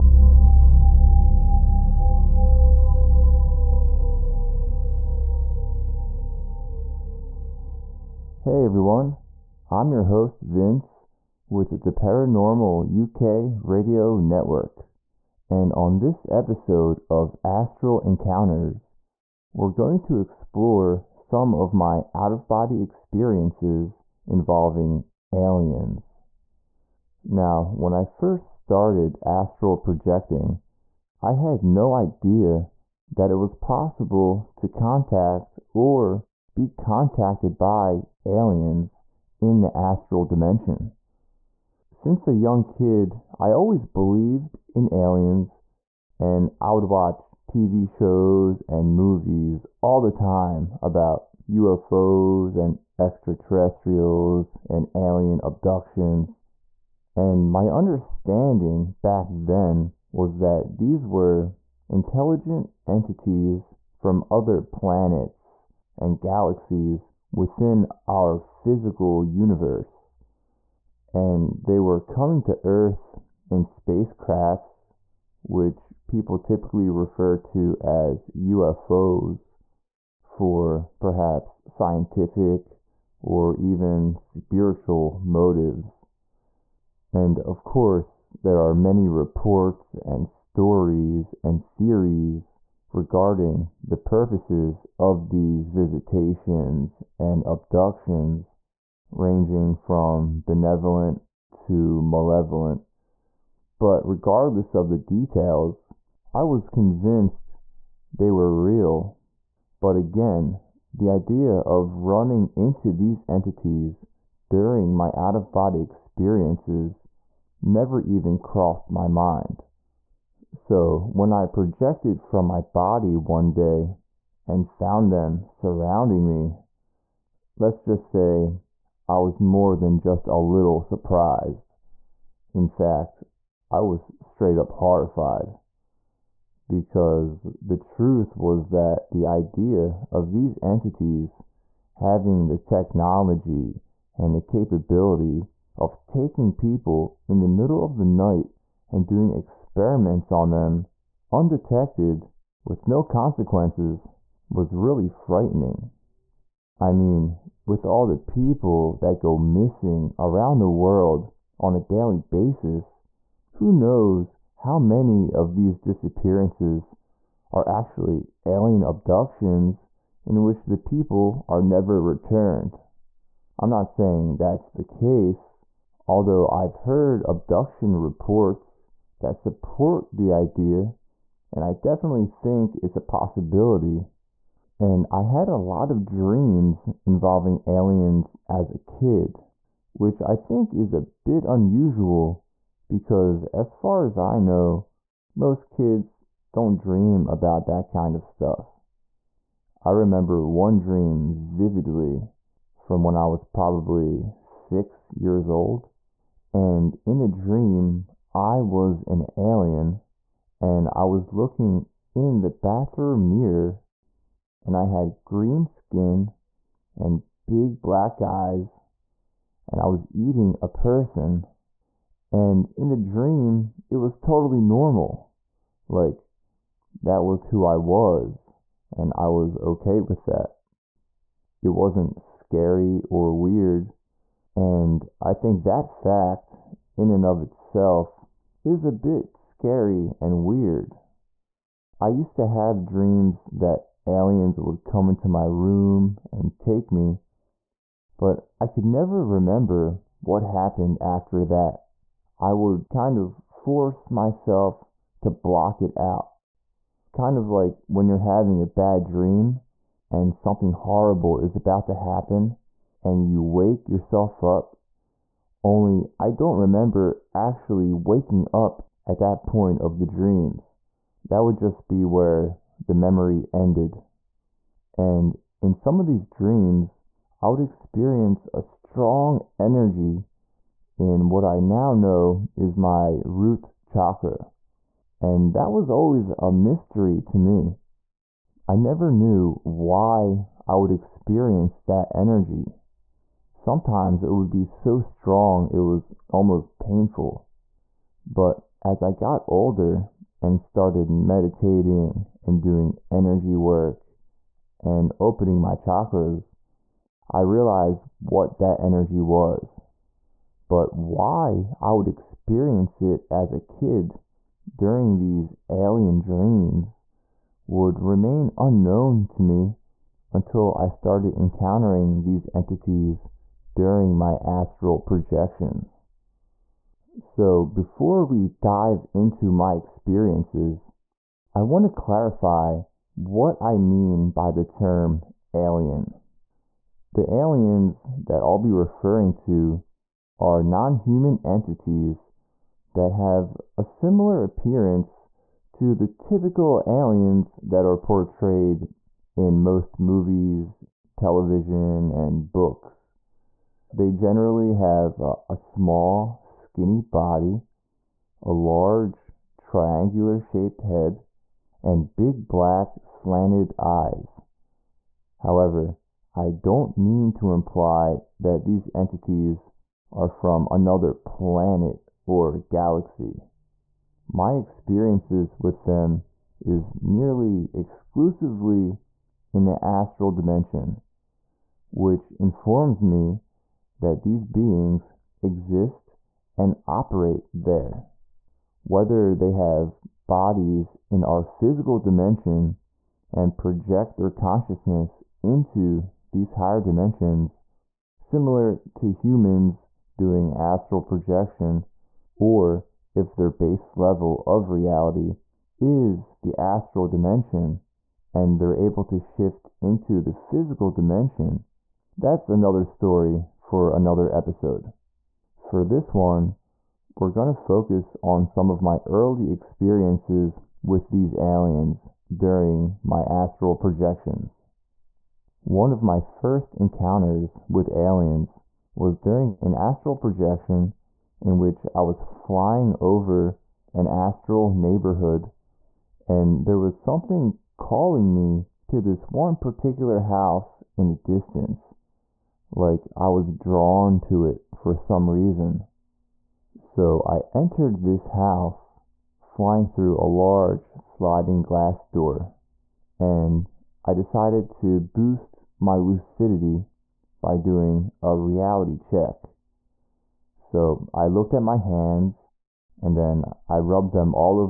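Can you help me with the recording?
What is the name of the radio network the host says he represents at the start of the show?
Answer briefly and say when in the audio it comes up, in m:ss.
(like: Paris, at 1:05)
Paranormal UK Radio Network, at 0:11.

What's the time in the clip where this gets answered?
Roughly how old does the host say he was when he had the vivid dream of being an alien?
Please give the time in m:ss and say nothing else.
3:24.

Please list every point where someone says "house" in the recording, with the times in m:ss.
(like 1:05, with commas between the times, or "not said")
7:20, 7:28.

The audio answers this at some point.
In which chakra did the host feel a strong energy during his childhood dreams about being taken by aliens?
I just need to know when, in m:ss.
4:43.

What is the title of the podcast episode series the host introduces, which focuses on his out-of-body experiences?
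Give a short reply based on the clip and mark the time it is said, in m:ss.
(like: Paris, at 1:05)
Astral Encounters, at 0:17.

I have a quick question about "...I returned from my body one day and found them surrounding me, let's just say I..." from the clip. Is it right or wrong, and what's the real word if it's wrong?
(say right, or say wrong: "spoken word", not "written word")
wrong: "projected", not "returned".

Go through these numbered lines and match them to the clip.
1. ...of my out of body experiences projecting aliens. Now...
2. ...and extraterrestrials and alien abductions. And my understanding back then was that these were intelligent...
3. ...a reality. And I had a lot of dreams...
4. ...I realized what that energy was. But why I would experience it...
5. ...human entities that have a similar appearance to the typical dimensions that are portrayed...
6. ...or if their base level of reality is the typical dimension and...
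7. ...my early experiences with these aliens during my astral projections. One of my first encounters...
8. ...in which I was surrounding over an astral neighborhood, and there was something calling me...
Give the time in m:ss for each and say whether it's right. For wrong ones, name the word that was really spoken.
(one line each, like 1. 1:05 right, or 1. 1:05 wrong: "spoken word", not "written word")
1. 0:21 wrong: "involving", not "projecting"
2. 0:52 right
3. 3:02 wrong: "possibility", not "reality"
4. 5:07 right
5. 5:40 wrong: "aliens", not "dimensions"
6. 6:42 wrong: "astral", not "typical"
7. 6:58 right
8. 7:11 wrong: "flying", not "surrounding".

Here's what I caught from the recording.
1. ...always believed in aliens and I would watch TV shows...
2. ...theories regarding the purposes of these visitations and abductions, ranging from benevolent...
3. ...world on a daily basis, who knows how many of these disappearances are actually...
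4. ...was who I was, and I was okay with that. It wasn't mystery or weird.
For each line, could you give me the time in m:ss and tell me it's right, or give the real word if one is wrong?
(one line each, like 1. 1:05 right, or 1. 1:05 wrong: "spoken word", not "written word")
1. 0:43 right
2. 1:31 right
3. 2:40 right
4. 3:47 wrong: "scary", not "mystery".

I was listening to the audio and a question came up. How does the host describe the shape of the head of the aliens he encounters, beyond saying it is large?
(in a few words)
triangular.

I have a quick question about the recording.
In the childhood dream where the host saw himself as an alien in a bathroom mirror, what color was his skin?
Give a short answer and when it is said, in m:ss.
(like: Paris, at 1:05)
green, at 3:35.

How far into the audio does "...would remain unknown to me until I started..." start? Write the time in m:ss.
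5:17.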